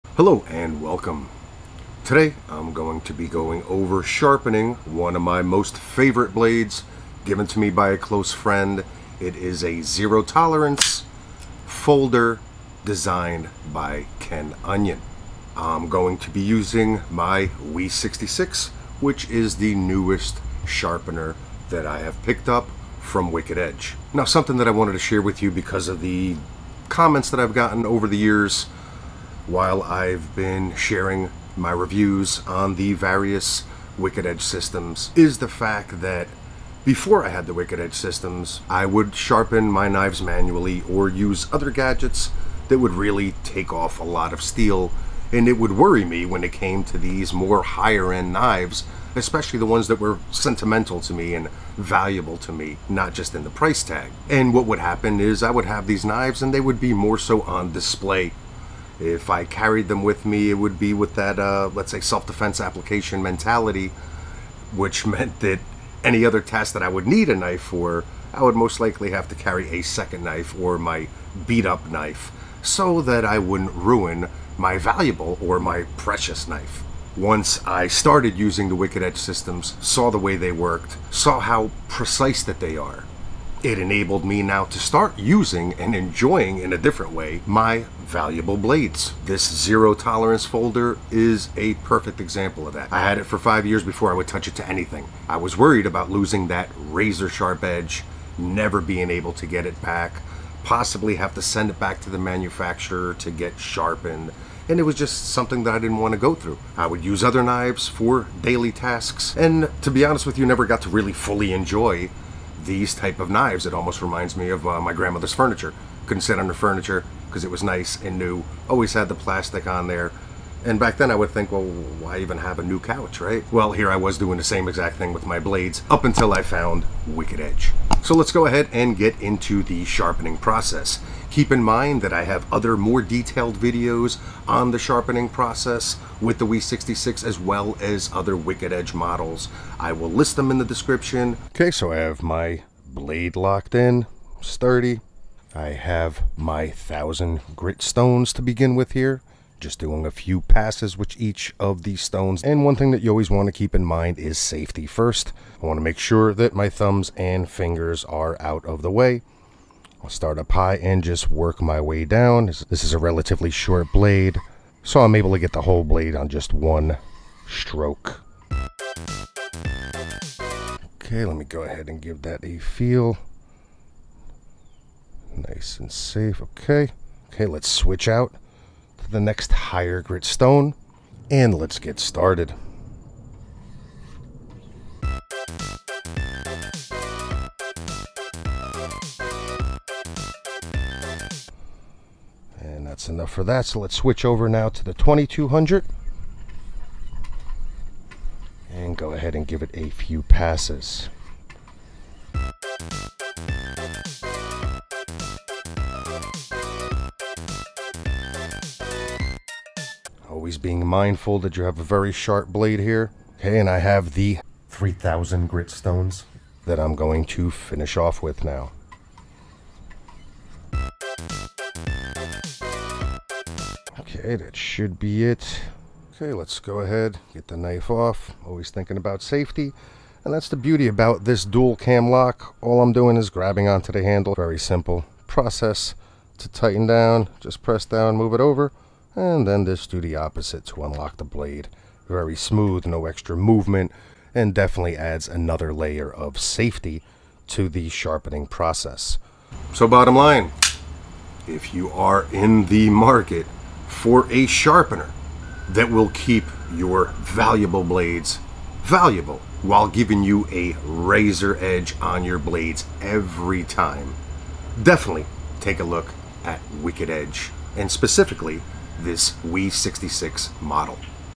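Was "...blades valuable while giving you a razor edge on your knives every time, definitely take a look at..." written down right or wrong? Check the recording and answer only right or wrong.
wrong.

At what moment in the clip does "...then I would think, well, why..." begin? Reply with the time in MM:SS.
02:00.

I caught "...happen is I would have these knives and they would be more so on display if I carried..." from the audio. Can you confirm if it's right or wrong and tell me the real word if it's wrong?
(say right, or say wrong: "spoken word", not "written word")
right.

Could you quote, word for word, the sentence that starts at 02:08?
So let's go ahead and get into the sharpening process.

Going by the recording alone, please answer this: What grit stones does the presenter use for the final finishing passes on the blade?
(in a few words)
3000.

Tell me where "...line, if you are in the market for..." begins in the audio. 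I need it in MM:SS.
04:10.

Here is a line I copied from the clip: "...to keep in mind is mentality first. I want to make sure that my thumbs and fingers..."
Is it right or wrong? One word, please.
wrong.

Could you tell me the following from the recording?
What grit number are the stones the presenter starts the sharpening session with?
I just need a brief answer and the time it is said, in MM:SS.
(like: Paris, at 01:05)
1000, at 02:26.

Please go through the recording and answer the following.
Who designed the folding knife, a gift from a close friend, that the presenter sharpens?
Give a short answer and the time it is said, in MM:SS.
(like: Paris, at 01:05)
Ken Onion, at 00:14.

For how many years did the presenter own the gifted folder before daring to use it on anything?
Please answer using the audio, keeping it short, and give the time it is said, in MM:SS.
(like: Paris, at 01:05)
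5 years, at 01:33.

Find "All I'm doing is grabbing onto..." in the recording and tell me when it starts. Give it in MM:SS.
03:52.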